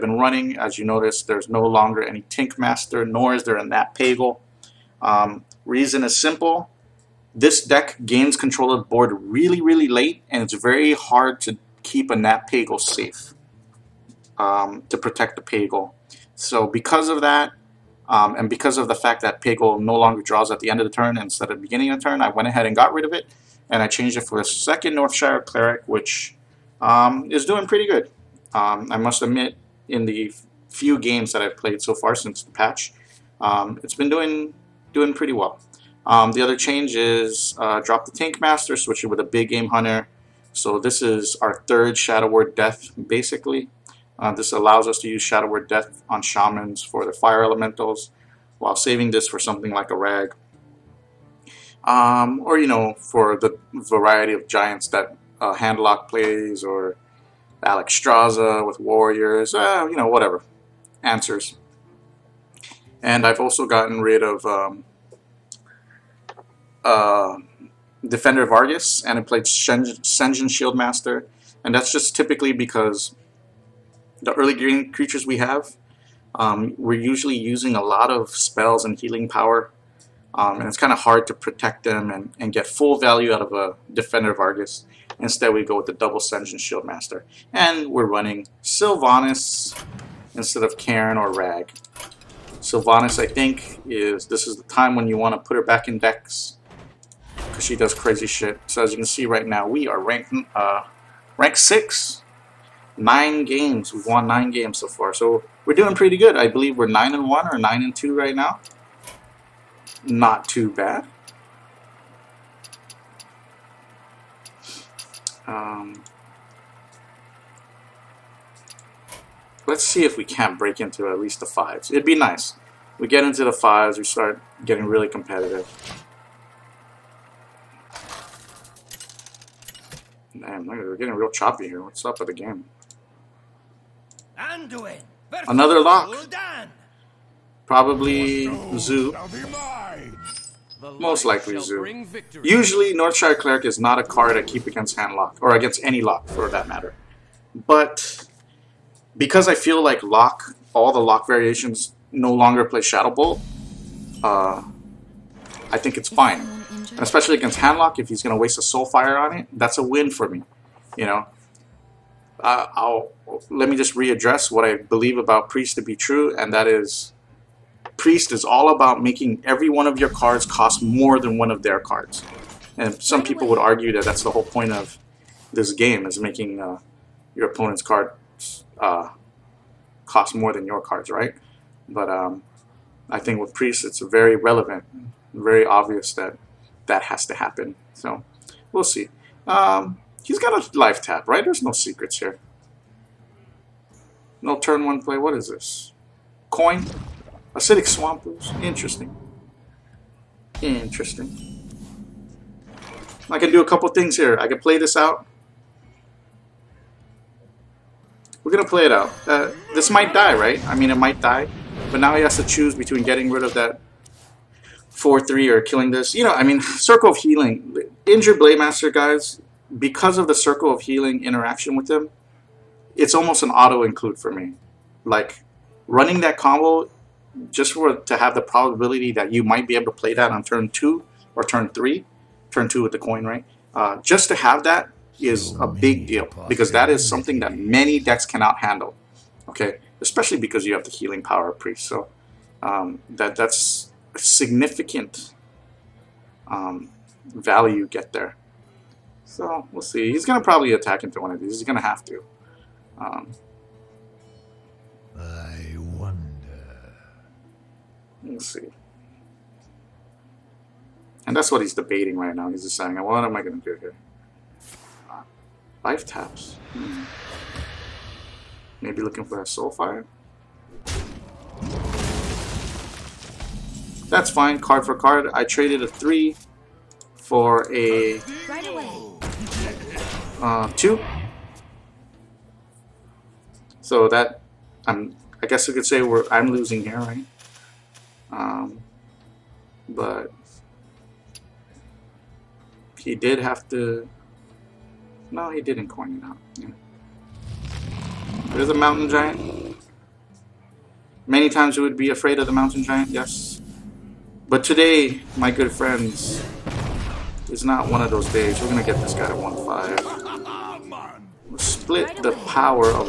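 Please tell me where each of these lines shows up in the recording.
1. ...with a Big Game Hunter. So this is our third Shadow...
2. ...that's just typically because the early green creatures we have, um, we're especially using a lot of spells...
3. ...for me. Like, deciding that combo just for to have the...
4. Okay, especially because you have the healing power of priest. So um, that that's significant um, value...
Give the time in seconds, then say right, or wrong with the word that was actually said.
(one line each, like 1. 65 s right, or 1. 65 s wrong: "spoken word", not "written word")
1. 39 s right
2. 71 s wrong: "usually", not "especially"
3. 224 s wrong: "running", not "deciding"
4. 239 s right.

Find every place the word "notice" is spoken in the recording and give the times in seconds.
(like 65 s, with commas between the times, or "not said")
0 s.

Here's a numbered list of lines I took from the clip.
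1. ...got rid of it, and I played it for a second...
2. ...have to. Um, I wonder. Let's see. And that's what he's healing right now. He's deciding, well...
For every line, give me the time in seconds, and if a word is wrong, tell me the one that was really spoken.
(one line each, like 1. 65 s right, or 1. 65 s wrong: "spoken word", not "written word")
1. 22 s wrong: "changed", not "played"
2. 251 s wrong: "debating", not "healing".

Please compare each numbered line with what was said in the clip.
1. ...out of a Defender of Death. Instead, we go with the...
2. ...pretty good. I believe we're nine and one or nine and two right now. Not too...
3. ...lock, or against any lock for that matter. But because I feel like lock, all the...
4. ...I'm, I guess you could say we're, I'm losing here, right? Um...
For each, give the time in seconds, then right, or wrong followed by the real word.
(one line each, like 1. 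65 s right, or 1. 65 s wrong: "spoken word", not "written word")
1. 83 s wrong: "Argus", not "Death"
2. 105 s right
3. 145 s right
4. 284 s right.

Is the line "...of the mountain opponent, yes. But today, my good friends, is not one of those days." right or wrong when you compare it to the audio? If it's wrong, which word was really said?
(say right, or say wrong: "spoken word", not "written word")
wrong: "giant", not "opponent".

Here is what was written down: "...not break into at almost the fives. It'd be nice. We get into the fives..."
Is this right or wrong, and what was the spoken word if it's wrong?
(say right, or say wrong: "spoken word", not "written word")
wrong: "least", not "almost".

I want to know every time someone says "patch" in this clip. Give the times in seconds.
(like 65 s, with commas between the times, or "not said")
32 s.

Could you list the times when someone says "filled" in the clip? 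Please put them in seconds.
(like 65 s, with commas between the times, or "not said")
not said.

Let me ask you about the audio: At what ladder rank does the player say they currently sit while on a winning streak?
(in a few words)
6.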